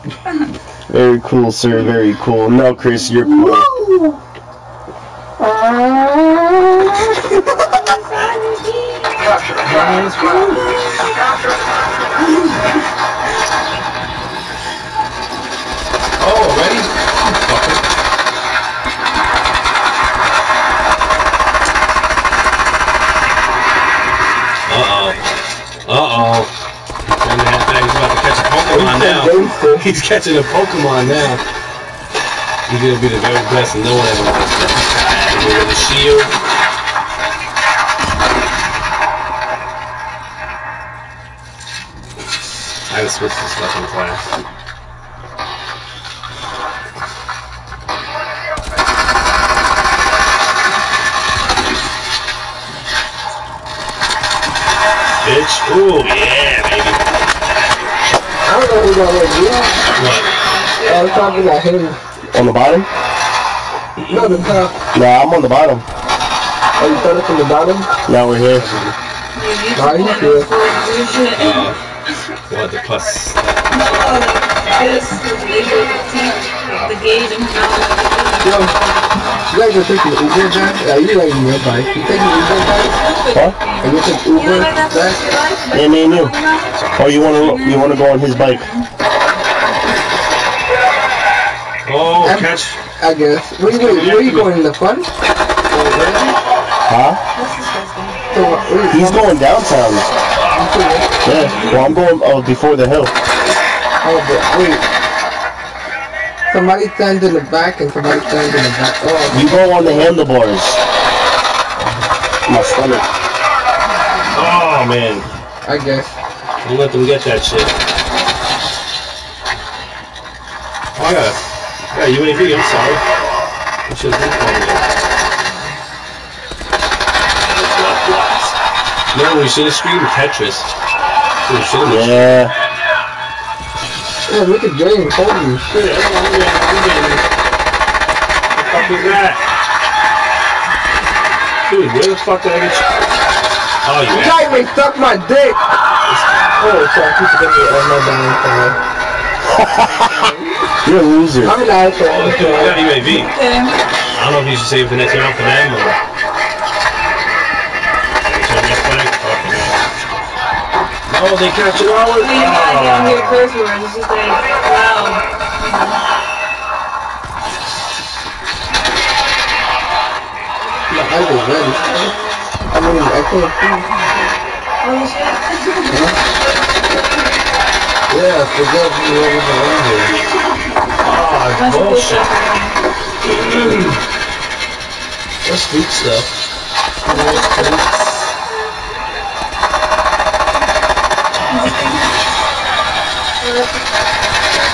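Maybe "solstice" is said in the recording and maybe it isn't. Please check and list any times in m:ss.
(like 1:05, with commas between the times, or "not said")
not said.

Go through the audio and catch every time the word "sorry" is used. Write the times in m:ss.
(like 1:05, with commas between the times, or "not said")
2:02, 2:26.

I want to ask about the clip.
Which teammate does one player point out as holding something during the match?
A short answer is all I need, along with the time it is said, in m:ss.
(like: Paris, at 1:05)
James, at 2:14.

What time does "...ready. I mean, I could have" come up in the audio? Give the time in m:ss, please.
2:51.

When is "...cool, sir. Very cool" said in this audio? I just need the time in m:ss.
0:01.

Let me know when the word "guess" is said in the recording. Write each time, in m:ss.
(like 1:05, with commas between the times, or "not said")
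1:33, 1:55.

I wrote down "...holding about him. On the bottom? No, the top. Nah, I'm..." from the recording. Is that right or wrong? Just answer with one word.
wrong.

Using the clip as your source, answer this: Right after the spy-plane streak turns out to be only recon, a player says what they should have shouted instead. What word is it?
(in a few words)
Tetris.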